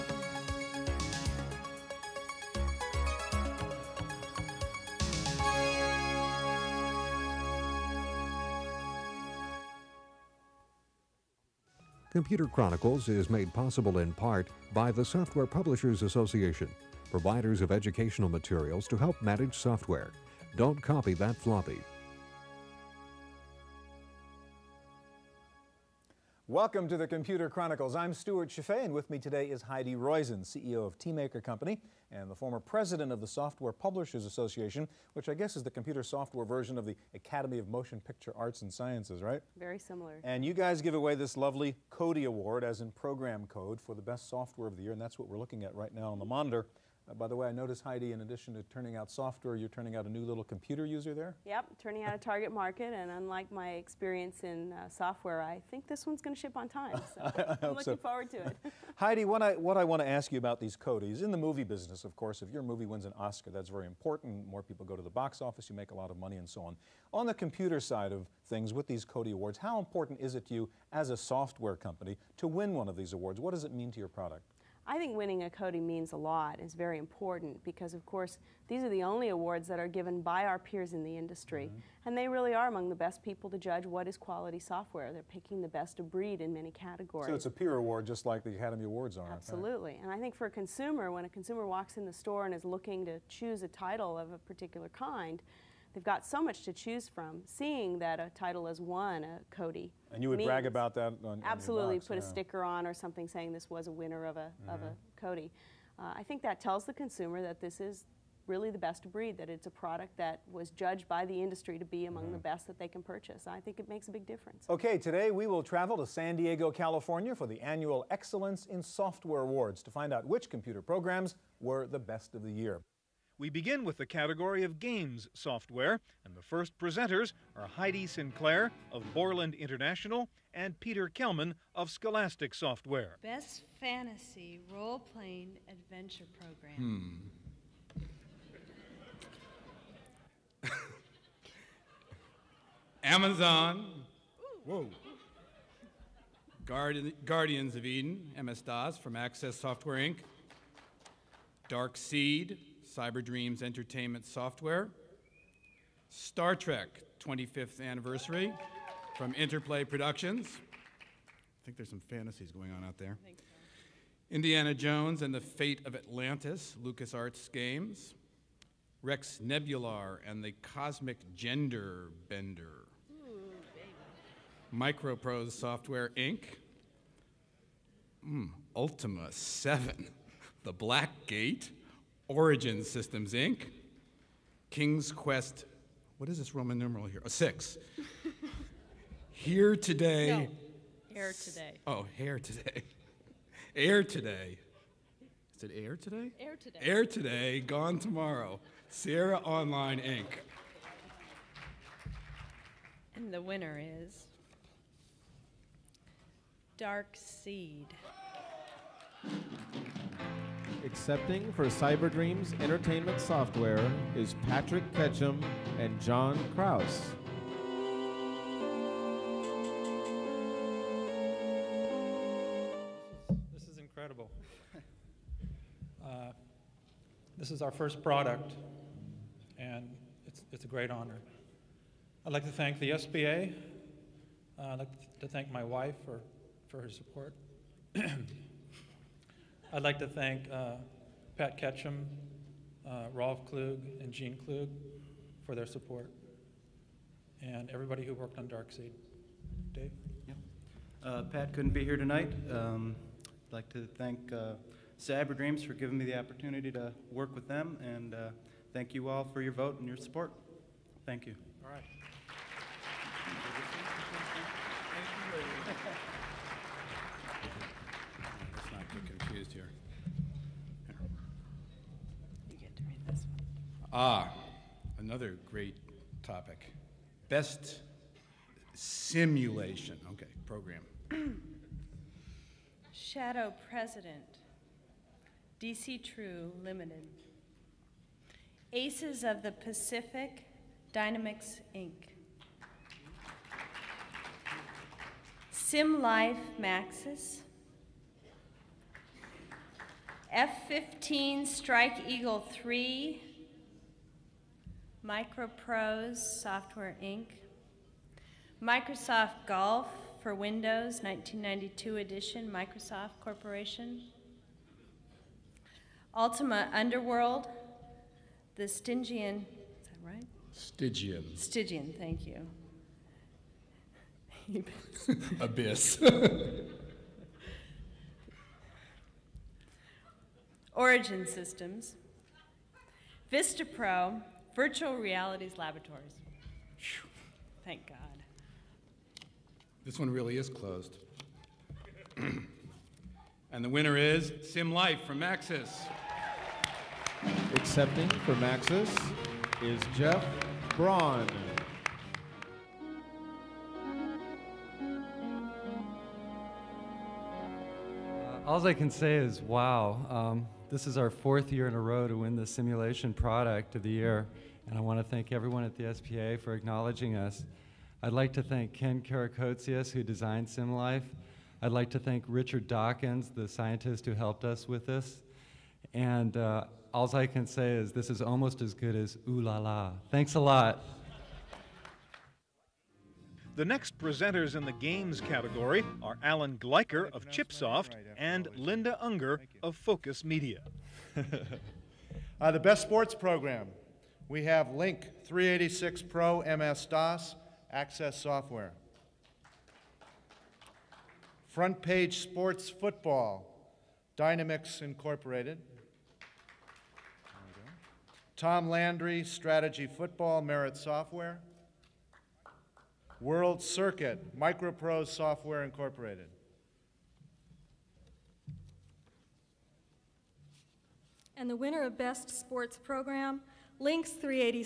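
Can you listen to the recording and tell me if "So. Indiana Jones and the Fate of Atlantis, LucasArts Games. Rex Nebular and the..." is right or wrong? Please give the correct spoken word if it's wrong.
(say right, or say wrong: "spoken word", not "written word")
right.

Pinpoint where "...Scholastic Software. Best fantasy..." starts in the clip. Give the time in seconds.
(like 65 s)
131 s.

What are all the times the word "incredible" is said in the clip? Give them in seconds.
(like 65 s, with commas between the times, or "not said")
223 s.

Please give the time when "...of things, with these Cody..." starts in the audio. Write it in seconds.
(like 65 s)
68 s.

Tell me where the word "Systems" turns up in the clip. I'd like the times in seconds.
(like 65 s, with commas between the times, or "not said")
182 s, 331 s.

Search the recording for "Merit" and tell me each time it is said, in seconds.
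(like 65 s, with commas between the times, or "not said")
410 s.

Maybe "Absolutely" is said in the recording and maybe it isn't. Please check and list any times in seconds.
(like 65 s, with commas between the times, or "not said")
89 s, 101 s.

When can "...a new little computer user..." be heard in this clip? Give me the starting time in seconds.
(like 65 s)
50 s.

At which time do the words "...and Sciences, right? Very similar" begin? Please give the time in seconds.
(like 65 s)
38 s.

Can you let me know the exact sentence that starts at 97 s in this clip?
Seeing that a title has won a Codie.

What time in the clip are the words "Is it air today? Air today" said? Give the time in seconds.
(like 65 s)
195 s.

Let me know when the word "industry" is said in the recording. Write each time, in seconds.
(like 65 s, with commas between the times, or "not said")
81 s, 111 s.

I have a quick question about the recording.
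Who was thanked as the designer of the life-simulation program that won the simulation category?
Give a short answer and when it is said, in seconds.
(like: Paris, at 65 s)
Ken Karakotsias, at 368 s.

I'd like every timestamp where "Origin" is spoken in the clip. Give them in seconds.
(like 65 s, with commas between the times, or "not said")
182 s, 330 s.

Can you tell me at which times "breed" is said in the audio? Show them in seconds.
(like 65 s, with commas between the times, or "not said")
86 s, 109 s.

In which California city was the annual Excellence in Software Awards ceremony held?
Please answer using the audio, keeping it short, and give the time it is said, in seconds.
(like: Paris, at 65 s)
San Diego, at 116 s.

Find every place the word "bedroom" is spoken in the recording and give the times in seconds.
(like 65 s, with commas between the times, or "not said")
not said.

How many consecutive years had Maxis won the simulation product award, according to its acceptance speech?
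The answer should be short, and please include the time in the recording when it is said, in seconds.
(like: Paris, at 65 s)
4, at 361 s.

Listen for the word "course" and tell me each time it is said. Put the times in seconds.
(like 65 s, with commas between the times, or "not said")
62 s, 78 s.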